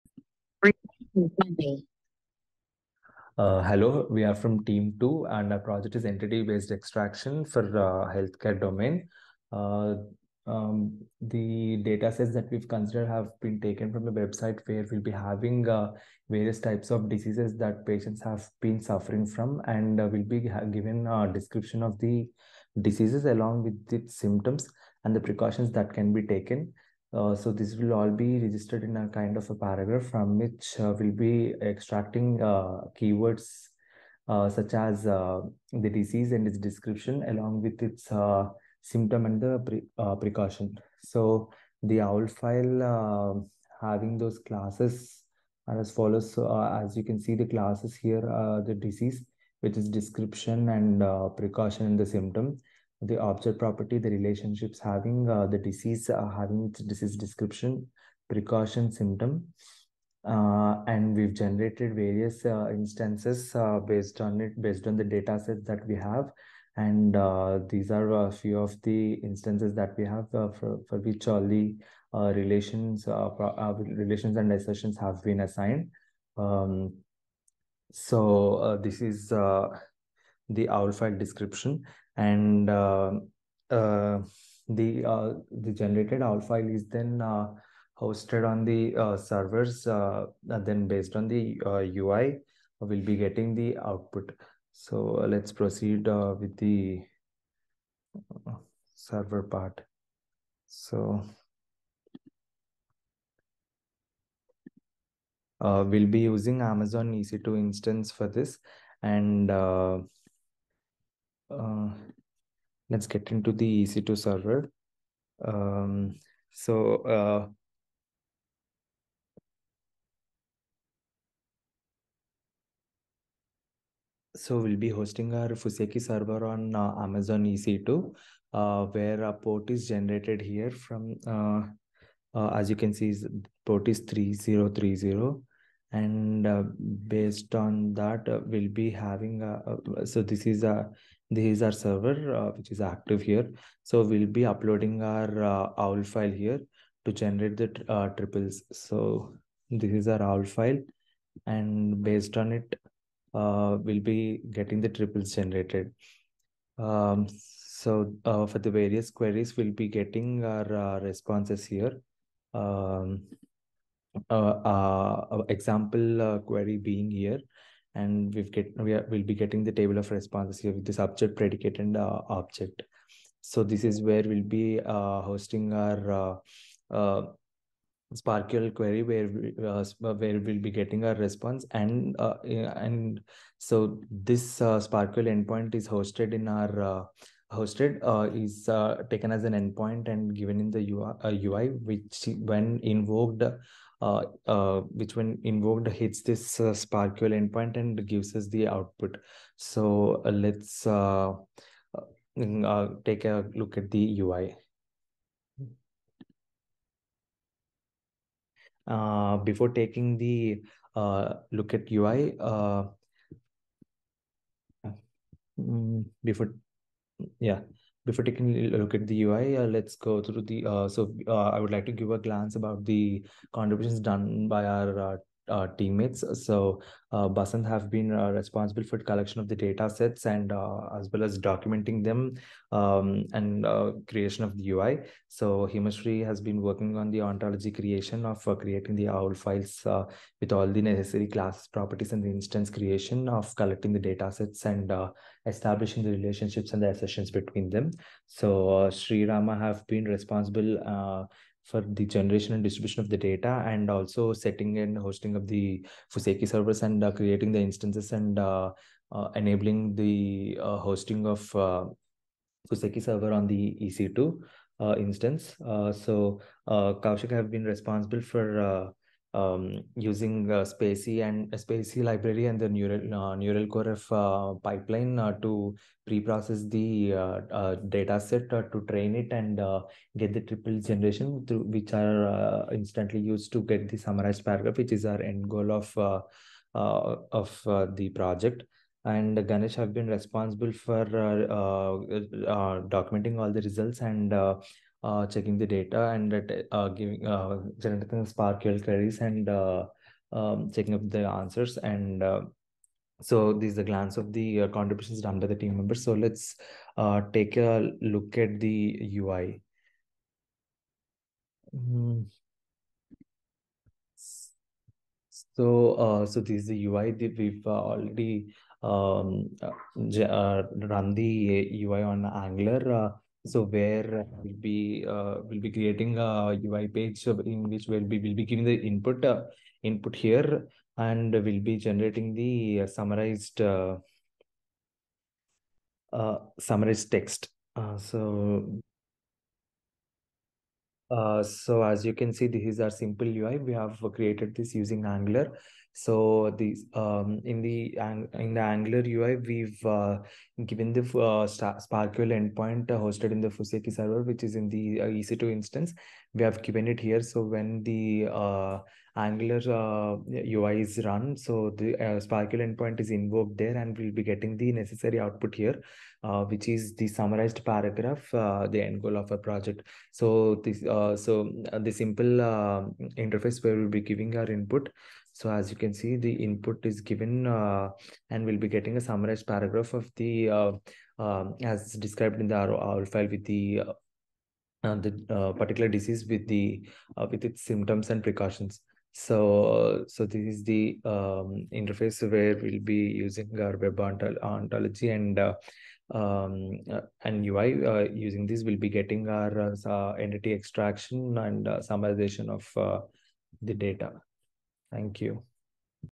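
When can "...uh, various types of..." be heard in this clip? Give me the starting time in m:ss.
0:15.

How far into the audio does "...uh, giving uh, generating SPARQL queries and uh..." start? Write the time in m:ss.
4:56.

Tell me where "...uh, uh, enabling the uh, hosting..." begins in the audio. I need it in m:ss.
4:18.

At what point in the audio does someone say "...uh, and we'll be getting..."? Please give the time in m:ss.
6:17.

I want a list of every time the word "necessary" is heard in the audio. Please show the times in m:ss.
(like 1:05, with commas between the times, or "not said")
4:00, 6:04.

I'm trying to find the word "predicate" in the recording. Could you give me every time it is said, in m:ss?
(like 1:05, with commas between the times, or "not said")
2:51.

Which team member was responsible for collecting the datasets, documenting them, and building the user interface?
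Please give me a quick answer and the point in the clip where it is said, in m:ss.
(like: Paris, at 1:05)
Basant, at 3:47.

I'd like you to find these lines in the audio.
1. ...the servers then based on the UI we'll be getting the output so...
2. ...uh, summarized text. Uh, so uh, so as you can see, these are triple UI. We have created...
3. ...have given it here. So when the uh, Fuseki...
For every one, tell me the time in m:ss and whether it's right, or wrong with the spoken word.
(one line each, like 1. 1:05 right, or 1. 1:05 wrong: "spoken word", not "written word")
1. 1:28 right
2. 5:36 wrong: "simple", not "triple"
3. 5:56 wrong: "Angular", not "Fuseki".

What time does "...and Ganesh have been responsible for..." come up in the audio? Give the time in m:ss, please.
4:49.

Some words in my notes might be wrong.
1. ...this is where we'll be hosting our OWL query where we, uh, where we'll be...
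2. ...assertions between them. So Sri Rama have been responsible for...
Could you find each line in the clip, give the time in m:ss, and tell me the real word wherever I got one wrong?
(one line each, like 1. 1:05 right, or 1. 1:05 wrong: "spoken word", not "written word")
1. 2:53 wrong: "SPARQL", not "OWL"
2. 4:06 right.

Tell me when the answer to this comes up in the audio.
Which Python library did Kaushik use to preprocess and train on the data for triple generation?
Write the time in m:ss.
4:31.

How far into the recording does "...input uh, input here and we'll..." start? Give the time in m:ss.
5:28.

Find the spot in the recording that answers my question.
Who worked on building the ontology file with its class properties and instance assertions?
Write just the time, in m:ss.
3:55.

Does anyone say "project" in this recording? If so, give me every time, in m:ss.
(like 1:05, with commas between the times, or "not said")
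0:05, 4:48, 6:09.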